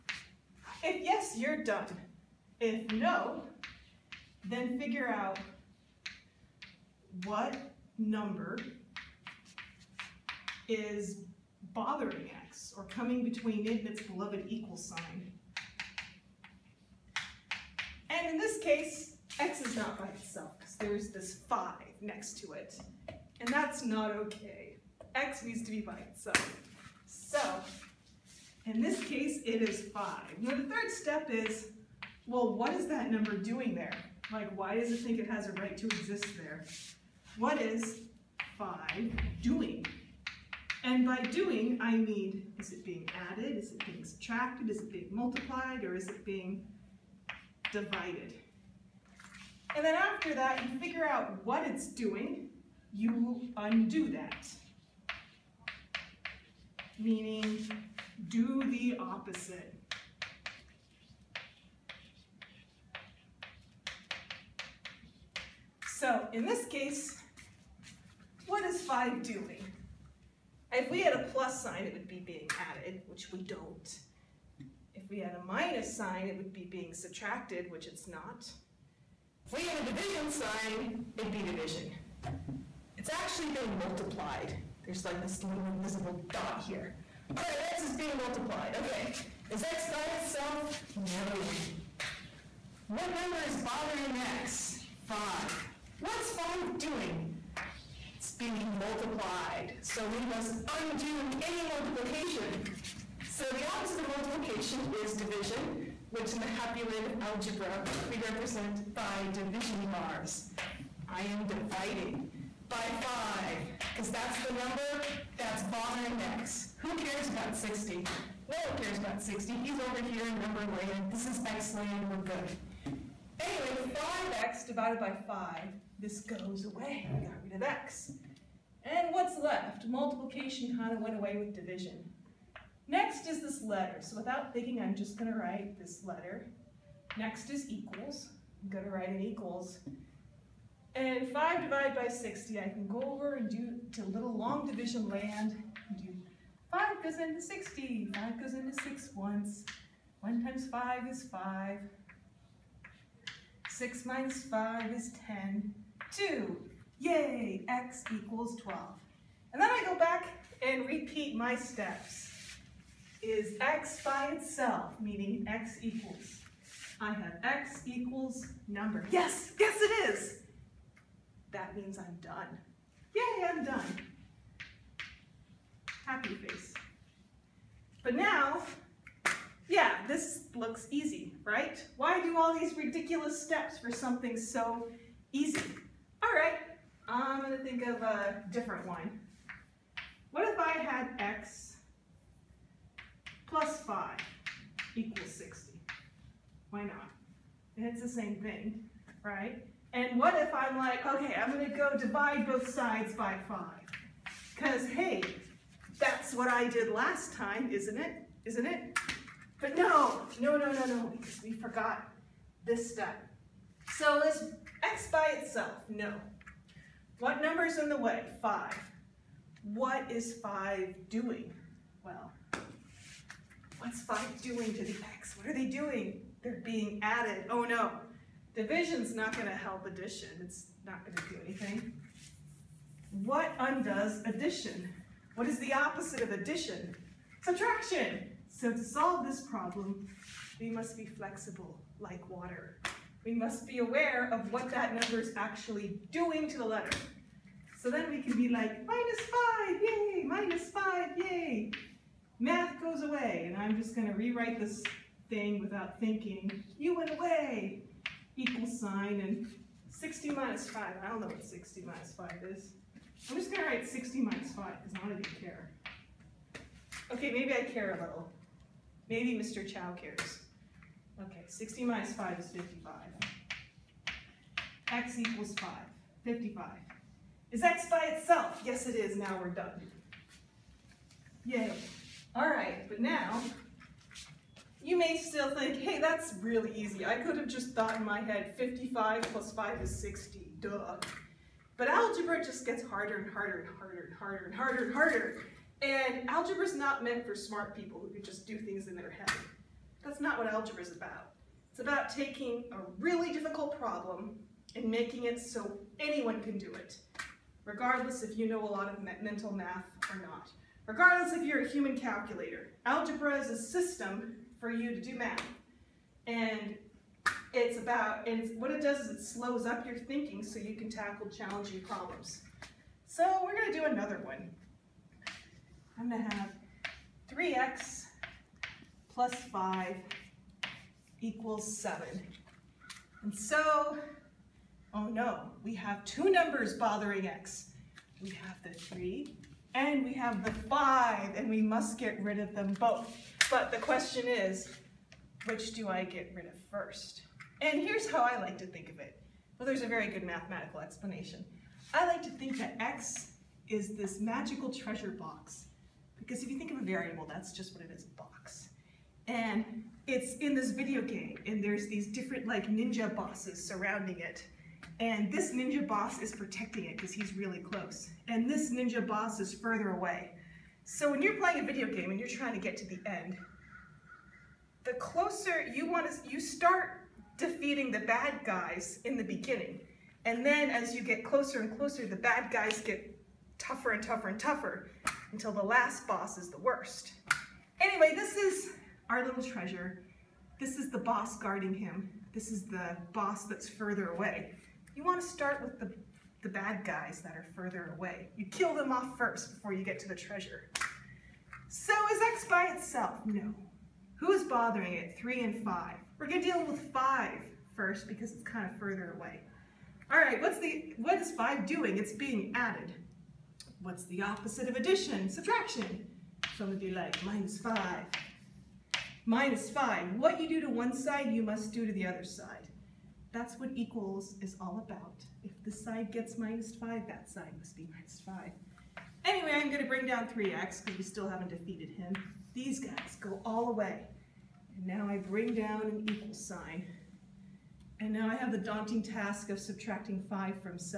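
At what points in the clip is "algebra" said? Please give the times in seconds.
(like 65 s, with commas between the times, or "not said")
107 s, 291 s, 296 s, 300 s, 312 s.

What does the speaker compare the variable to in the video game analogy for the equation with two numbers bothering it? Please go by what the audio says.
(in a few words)
treasure box.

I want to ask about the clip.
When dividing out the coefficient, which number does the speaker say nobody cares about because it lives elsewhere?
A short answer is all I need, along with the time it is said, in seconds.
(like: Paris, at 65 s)
60, at 118 s.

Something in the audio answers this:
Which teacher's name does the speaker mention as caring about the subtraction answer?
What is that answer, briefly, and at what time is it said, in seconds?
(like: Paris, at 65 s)
Mr. Chow, at 269 s.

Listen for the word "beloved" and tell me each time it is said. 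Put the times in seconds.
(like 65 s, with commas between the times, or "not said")
14 s.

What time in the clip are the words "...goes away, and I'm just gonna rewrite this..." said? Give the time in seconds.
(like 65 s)
252 s.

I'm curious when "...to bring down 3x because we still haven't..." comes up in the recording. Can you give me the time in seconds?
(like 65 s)
429 s.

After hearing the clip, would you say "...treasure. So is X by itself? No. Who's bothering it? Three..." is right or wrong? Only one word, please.
right.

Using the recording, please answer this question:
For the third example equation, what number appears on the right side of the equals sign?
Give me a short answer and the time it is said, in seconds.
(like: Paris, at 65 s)
7, at 331 s.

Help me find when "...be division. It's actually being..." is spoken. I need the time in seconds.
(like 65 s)
81 s.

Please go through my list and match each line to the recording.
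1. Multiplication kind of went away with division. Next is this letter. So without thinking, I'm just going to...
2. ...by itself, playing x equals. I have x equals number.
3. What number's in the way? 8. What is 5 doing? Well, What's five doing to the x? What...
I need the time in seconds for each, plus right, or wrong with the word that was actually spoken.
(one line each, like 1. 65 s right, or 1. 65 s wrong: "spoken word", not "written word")
1. 129 s right
2. 164 s wrong: "meaning", not "playing"
3. 217 s wrong: "5", not "8".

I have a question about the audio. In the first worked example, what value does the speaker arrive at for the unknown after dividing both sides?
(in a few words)
12.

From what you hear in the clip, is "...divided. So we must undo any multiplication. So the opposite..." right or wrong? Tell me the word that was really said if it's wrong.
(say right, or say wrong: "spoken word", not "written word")
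wrong: "multiplied", not "divided".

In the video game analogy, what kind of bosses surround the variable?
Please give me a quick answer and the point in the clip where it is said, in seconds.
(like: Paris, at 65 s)
ninja bosses, at 362 s.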